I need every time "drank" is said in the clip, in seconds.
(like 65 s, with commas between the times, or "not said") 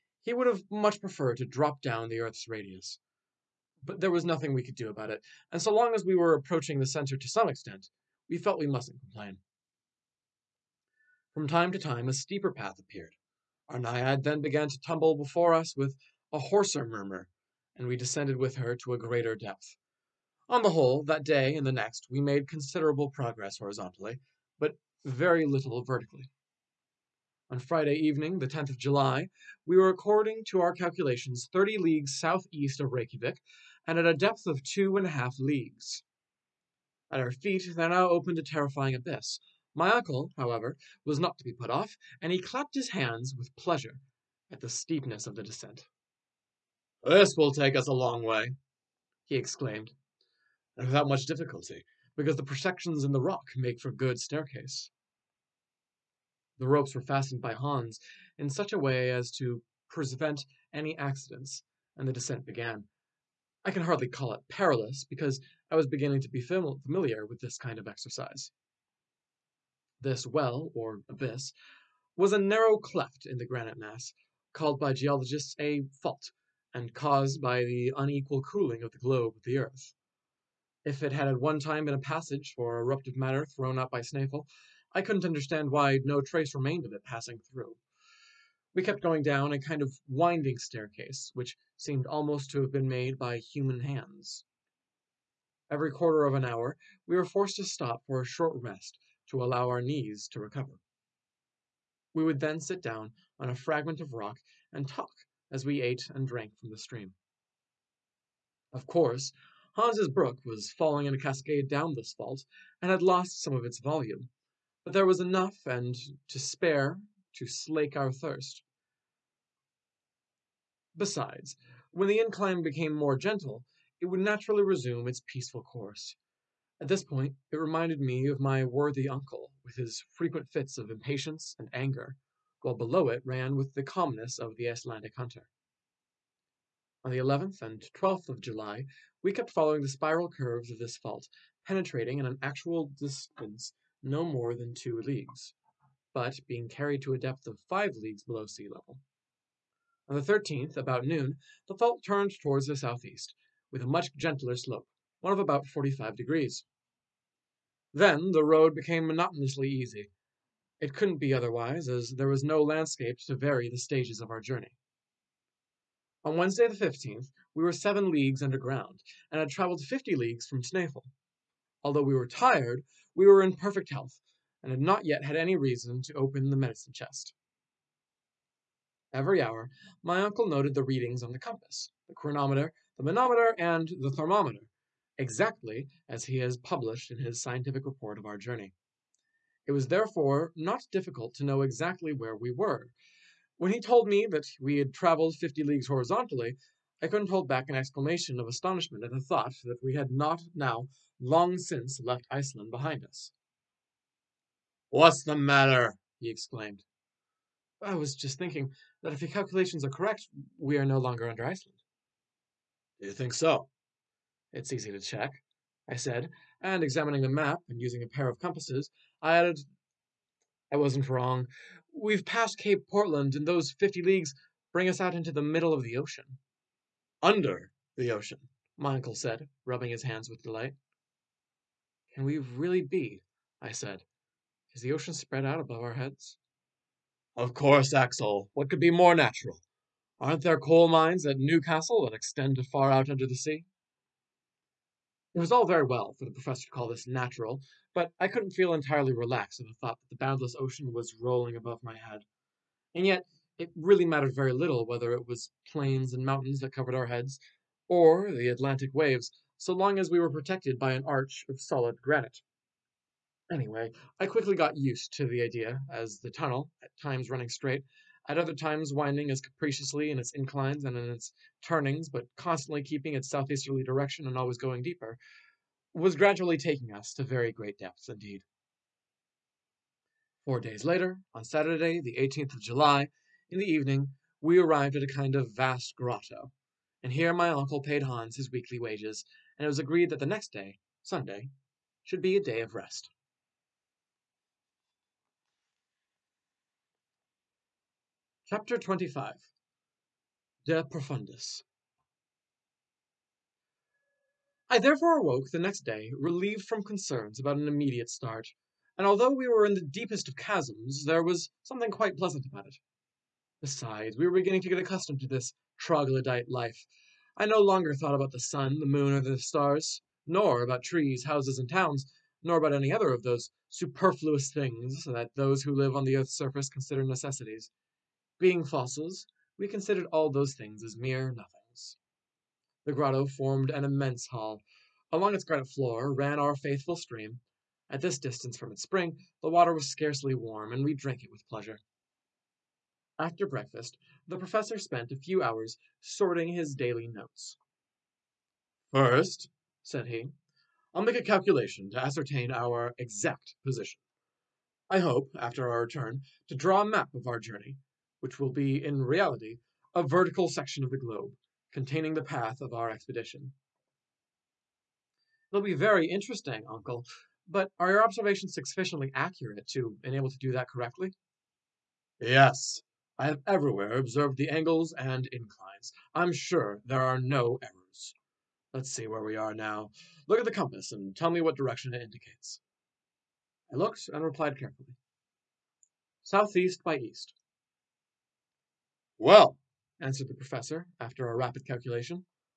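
106 s, 340 s.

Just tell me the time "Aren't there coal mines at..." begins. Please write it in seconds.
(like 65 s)
240 s.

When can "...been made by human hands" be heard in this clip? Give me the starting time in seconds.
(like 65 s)
92 s.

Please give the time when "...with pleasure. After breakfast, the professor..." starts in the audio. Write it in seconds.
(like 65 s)
341 s.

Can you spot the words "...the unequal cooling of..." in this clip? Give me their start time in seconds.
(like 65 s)
77 s.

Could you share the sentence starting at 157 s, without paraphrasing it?
Then the road became monotonously easy.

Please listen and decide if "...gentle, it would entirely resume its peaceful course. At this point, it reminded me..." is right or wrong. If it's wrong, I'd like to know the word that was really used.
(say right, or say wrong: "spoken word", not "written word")
wrong: "naturally", not "entirely".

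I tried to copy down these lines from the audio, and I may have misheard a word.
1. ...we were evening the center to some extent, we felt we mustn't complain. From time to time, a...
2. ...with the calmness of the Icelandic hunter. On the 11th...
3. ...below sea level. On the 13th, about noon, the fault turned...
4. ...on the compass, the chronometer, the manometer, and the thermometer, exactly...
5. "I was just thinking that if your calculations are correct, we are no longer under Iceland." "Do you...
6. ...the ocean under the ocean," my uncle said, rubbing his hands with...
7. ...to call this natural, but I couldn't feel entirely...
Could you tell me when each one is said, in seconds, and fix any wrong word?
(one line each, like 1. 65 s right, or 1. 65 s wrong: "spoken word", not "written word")
1. 6 s wrong: "approaching", not "evening"
2. 133 s right
3. 148 s right
4. 181 s right
5. 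207 s right
6. 225 s right
7. 246 s right.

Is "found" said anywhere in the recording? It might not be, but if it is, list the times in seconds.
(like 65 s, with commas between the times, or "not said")
not said.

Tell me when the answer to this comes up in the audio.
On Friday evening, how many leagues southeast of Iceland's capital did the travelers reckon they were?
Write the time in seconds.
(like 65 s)
31 s.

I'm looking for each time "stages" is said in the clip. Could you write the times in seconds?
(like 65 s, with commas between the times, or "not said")
163 s.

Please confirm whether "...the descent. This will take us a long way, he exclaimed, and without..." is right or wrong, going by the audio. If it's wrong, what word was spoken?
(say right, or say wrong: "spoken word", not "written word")
right.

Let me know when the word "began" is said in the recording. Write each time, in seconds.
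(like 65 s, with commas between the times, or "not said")
14 s, 62 s.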